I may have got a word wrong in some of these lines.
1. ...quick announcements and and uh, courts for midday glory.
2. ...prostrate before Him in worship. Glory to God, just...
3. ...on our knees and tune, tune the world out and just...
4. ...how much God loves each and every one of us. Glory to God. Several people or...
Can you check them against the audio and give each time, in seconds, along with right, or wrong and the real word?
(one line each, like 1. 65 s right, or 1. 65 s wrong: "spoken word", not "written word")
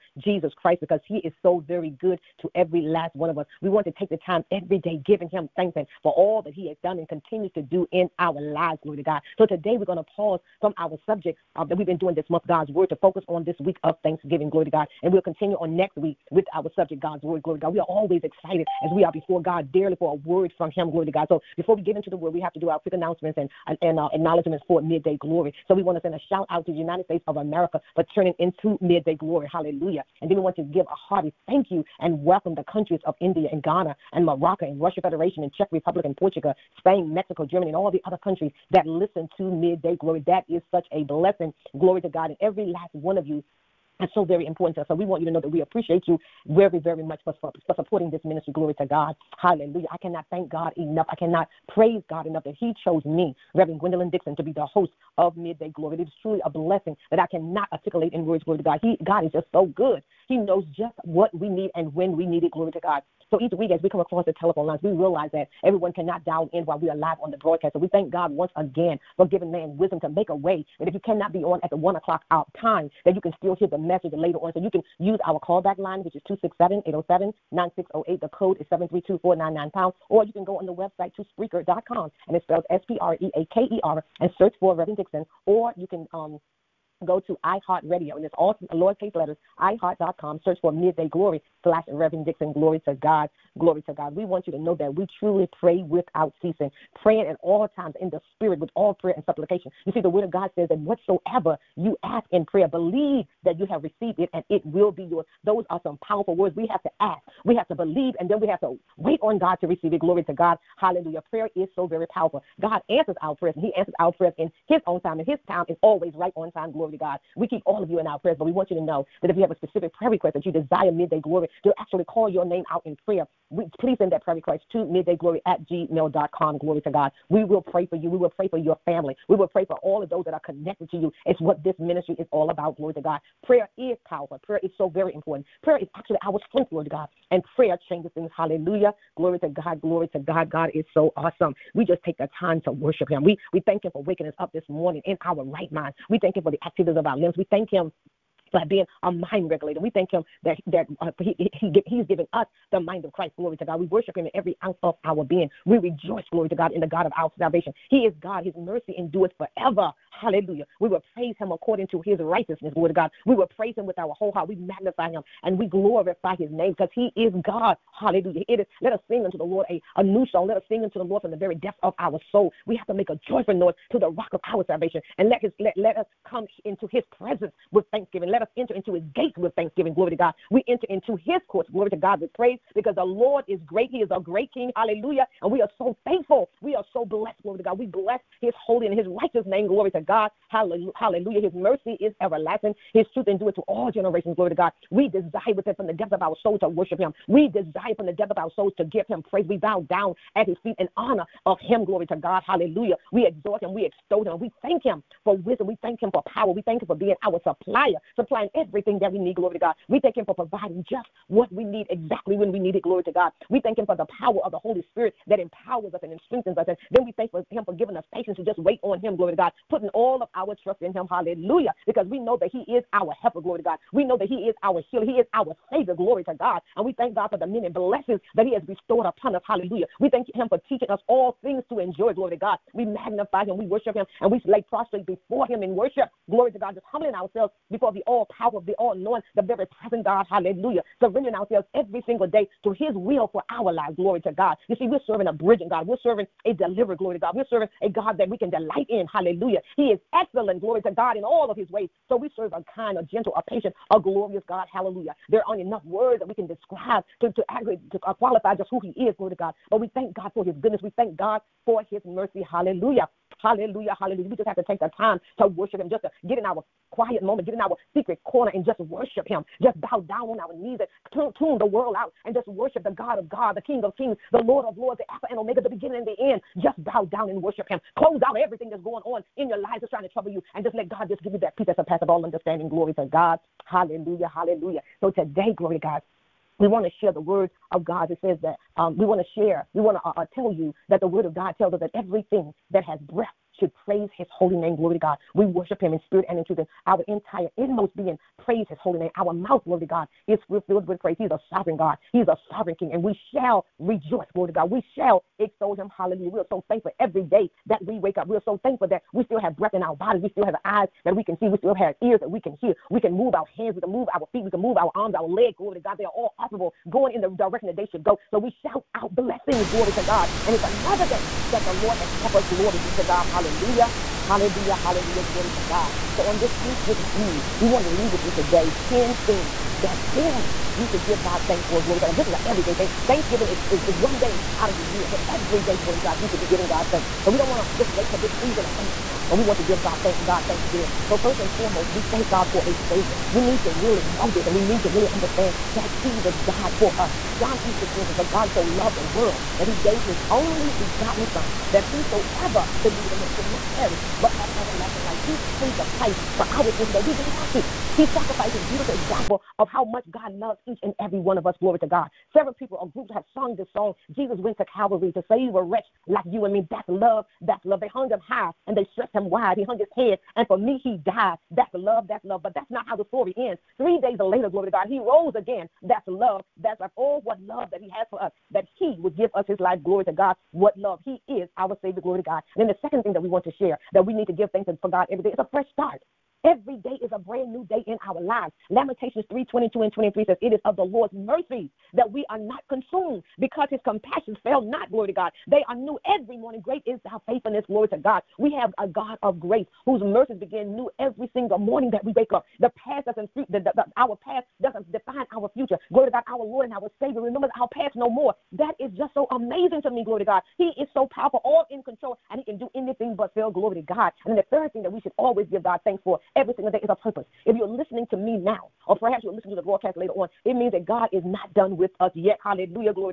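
1. 22 s wrong: "acknowledgments", not "courts"
2. 234 s right
3. 270 s right
4. 359 s right.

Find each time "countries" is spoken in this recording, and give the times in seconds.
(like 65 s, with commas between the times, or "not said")
32 s, 38 s.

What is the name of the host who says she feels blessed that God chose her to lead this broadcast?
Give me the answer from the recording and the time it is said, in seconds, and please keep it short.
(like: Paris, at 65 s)
Reverend Gwendolyn Dixon, at 53 s.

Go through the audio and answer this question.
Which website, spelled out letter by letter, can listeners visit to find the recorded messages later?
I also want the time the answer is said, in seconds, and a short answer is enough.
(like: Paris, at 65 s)
Spreaker.com, at 81 s.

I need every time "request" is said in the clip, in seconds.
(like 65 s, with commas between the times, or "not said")
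120 s, 124 s.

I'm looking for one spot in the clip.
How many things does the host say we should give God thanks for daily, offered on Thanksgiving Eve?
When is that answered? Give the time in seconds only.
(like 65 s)
328 s.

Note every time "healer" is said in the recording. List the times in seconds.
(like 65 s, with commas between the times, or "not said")
224 s.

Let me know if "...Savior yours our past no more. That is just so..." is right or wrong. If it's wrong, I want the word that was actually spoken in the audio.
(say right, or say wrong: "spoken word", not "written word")
wrong: "remembers", not "yours".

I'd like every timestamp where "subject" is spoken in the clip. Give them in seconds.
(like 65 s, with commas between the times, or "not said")
11 s, 16 s.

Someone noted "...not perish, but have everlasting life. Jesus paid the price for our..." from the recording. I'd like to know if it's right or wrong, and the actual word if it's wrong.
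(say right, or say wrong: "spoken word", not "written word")
right.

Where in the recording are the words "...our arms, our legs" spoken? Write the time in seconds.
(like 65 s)
314 s.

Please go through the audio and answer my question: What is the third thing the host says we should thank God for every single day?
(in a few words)
A purpose.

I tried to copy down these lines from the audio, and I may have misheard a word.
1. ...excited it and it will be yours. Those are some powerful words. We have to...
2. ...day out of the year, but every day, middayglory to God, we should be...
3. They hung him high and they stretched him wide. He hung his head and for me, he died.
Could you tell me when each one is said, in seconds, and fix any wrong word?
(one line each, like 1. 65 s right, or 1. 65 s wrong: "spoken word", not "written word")
1. 103 s wrong: "received", not "excited"
2. 334 s wrong: "glory", not "middayglory"
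3. 367 s right.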